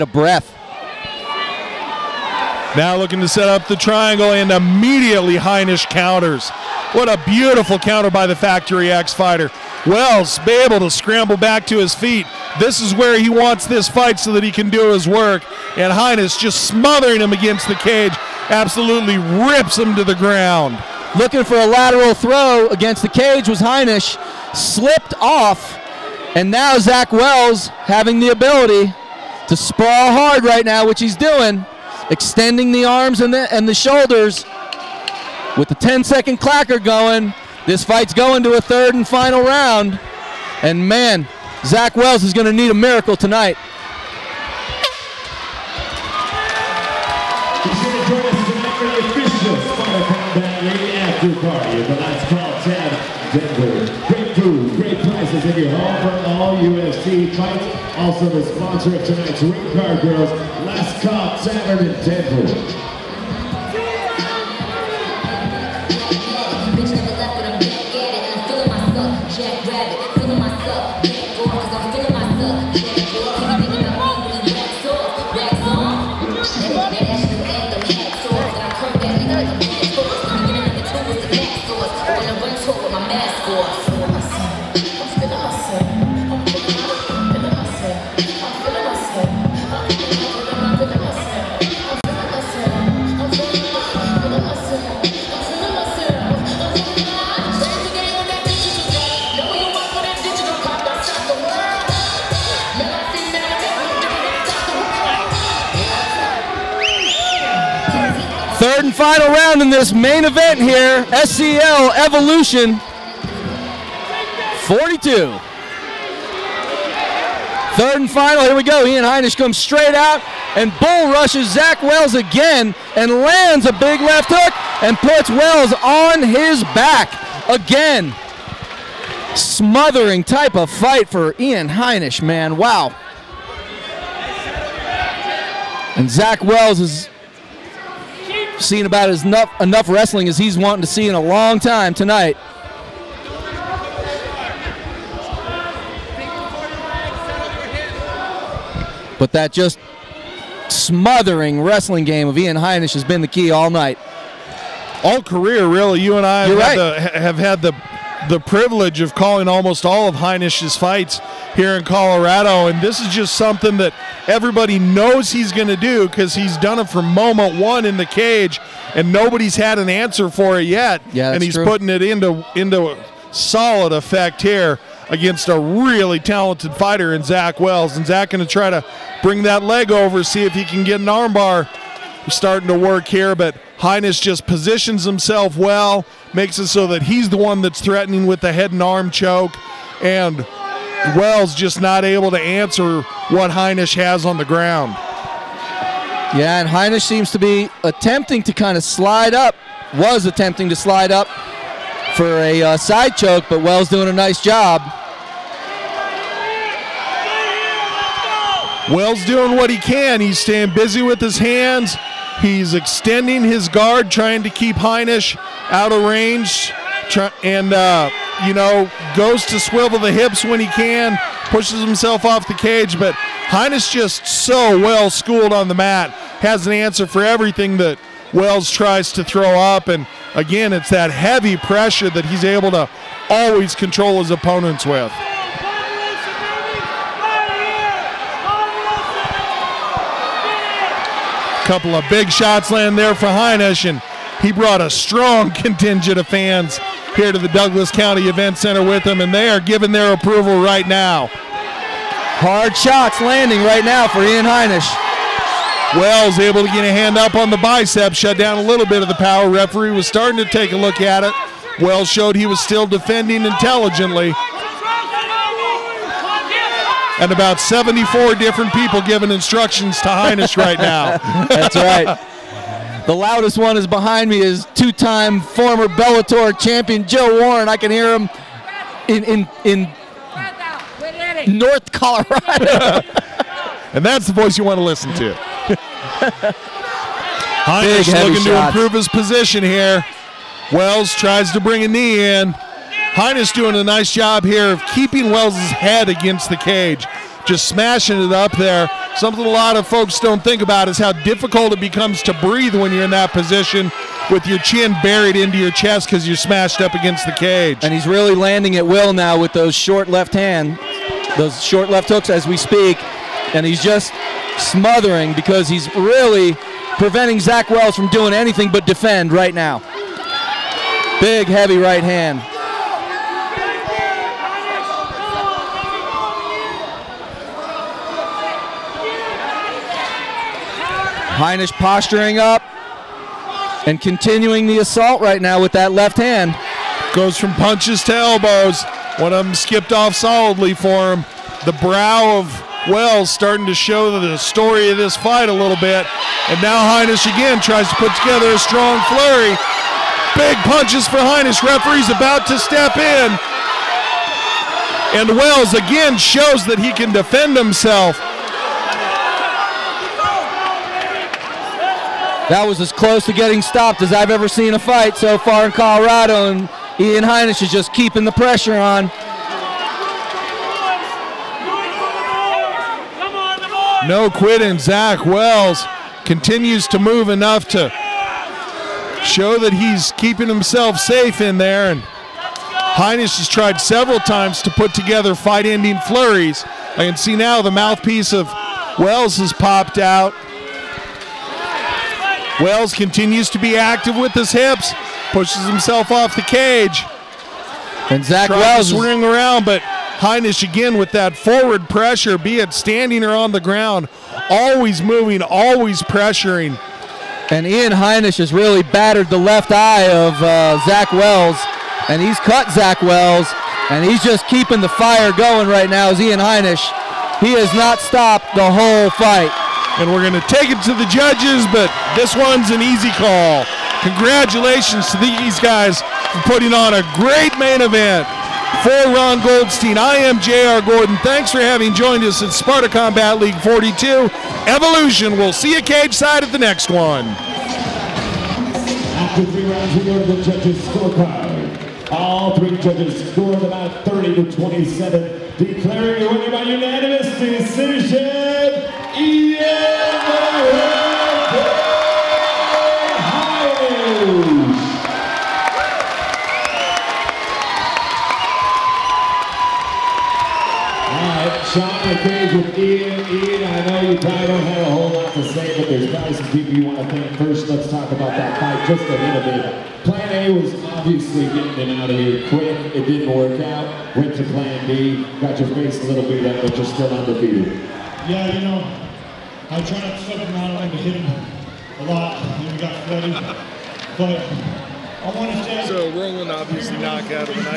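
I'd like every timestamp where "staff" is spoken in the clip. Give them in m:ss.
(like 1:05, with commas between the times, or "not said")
not said.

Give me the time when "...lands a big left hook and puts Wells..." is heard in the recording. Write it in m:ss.
2:03.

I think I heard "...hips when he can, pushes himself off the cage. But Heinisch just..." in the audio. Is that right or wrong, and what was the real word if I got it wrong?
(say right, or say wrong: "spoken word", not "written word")
right.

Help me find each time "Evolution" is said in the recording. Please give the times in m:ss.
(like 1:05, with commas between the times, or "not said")
1:52, 7:14.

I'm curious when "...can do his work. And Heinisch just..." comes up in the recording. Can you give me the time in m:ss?
0:14.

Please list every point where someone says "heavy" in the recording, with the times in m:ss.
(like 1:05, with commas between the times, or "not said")
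3:51, 5:21.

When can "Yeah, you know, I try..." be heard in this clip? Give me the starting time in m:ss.
7:58.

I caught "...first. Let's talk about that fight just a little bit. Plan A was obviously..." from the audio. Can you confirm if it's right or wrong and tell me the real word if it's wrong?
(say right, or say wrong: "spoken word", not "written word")
right.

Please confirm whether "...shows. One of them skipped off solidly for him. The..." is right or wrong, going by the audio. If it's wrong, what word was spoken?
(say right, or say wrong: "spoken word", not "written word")
wrong: "elbows", not "shows".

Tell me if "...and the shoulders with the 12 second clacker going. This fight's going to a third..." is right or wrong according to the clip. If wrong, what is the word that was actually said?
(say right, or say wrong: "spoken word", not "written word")
wrong: "10", not "12".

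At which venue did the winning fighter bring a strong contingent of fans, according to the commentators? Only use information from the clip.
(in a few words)
Douglas County Event Center.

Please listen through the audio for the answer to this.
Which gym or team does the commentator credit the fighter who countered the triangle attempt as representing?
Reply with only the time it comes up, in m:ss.
0:08.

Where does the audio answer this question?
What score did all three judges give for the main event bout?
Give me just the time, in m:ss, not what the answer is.
7:24.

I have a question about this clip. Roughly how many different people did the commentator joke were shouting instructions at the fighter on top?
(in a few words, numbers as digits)
74.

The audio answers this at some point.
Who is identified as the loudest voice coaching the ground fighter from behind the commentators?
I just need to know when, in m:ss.
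4:37.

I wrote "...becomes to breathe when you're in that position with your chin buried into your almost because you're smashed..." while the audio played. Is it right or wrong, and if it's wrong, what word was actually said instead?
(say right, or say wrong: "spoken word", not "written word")
wrong: "chest", not "almost".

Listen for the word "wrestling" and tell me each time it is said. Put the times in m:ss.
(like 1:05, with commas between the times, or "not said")
2:19, 2:31.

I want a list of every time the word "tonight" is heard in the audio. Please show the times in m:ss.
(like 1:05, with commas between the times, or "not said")
0:43, 0:59, 2:21.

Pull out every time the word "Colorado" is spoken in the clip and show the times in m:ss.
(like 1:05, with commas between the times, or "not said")
2:41, 4:41, 6:05.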